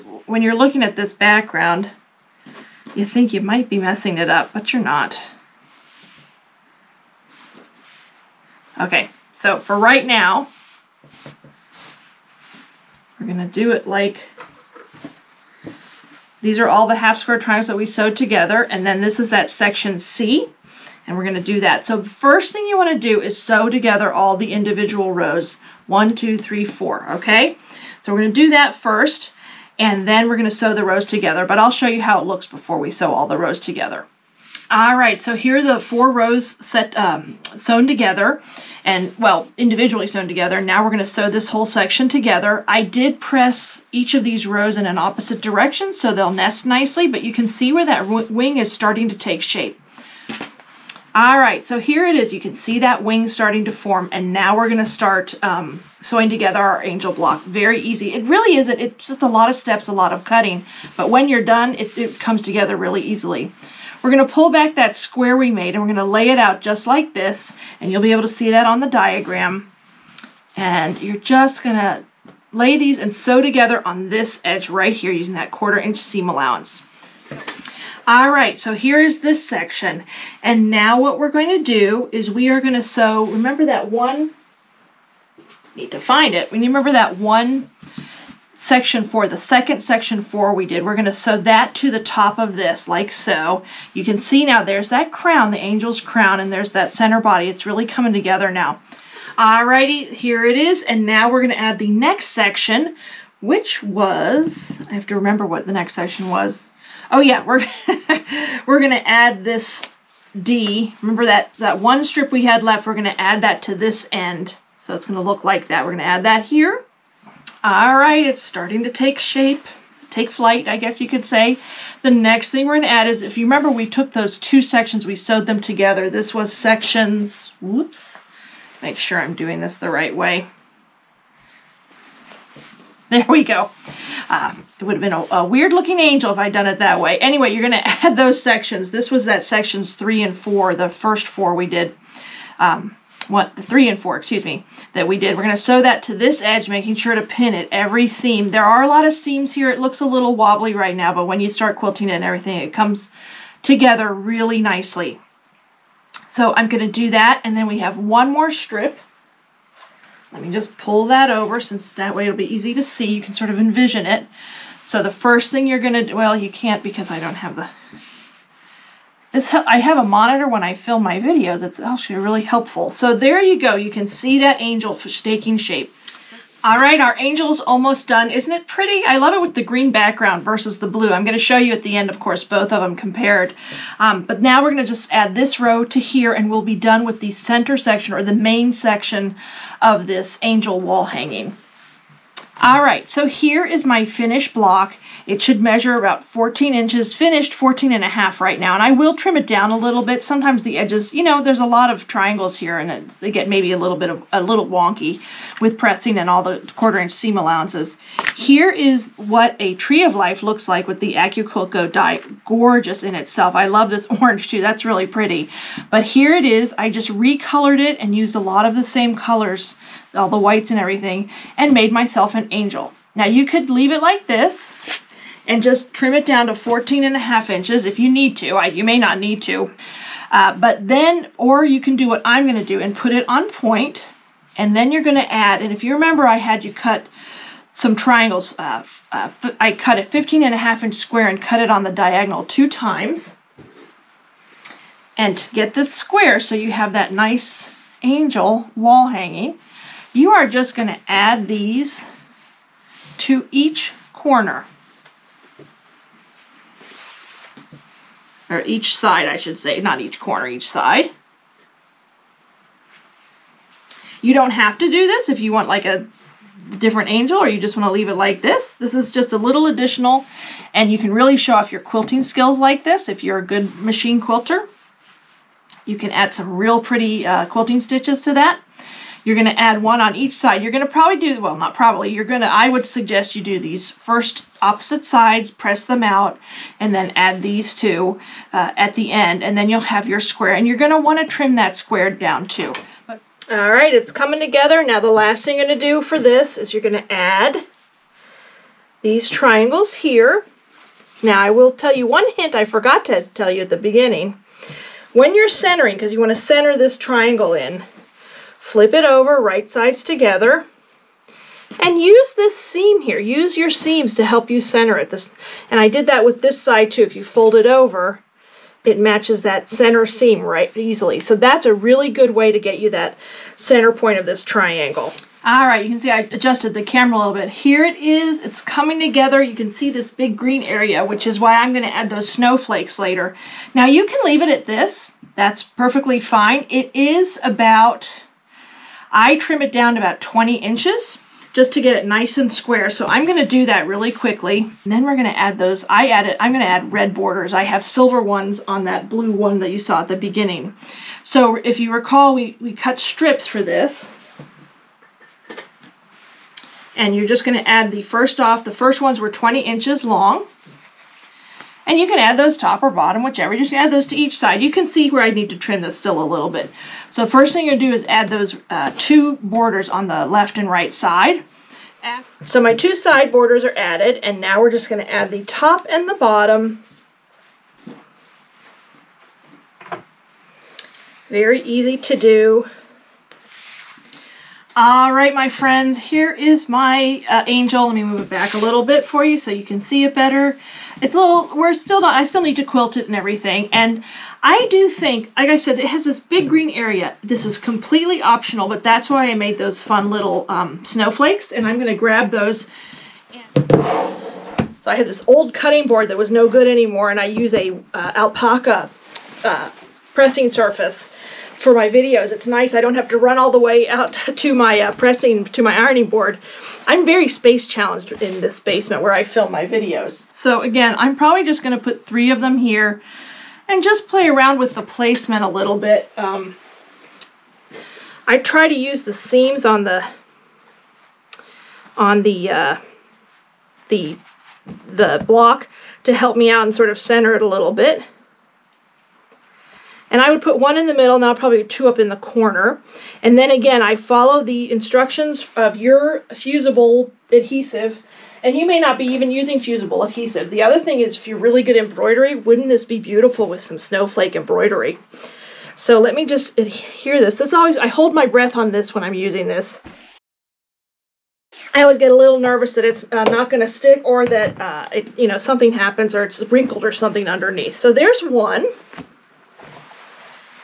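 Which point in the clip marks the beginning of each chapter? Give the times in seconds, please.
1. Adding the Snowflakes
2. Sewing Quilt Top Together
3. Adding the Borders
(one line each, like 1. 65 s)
1. 406 s
2. 58 s
3. 355 s.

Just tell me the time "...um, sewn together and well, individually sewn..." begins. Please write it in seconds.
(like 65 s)
36 s.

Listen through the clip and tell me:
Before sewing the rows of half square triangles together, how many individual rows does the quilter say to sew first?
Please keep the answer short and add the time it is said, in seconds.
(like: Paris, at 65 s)
4, at 25 s.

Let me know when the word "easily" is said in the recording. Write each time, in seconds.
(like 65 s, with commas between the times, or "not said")
62 s, 320 s.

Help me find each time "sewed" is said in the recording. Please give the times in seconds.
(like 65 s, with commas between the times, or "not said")
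17 s, 125 s.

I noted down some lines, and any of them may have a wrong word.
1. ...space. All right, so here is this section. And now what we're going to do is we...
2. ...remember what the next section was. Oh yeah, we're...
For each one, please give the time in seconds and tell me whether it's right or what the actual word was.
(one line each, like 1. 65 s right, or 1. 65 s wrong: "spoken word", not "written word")
1. 76 s wrong: "allowance", not "space"
2. 105 s right.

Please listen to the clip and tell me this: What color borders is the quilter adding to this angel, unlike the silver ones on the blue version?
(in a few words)
Red.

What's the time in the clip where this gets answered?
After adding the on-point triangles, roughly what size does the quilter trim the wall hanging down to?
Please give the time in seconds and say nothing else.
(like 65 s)
339 s.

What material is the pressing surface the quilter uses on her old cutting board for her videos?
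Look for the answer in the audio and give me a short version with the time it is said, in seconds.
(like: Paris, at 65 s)
Alpaca, at 408 s.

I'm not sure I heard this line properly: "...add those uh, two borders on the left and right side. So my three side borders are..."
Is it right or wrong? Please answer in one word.
wrong.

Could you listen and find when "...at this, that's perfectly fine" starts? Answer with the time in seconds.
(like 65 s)
334 s.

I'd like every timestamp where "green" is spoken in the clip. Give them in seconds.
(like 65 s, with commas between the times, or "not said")
179 s, 330 s, 396 s.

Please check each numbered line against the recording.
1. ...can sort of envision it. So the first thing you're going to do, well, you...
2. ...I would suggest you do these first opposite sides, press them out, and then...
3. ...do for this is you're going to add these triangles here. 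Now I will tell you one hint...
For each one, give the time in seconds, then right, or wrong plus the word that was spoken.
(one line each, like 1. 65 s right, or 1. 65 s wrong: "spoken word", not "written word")
1. 163 s right
2. 282 s right
3. 295 s right.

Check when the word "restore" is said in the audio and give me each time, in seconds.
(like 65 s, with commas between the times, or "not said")
not said.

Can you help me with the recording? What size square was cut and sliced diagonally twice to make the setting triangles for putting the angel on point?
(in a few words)
15 and a half inches.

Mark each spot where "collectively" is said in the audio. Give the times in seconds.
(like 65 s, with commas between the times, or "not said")
not said.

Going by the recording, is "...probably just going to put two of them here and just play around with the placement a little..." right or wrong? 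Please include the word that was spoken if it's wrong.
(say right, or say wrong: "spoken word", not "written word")
wrong: "three", not "two".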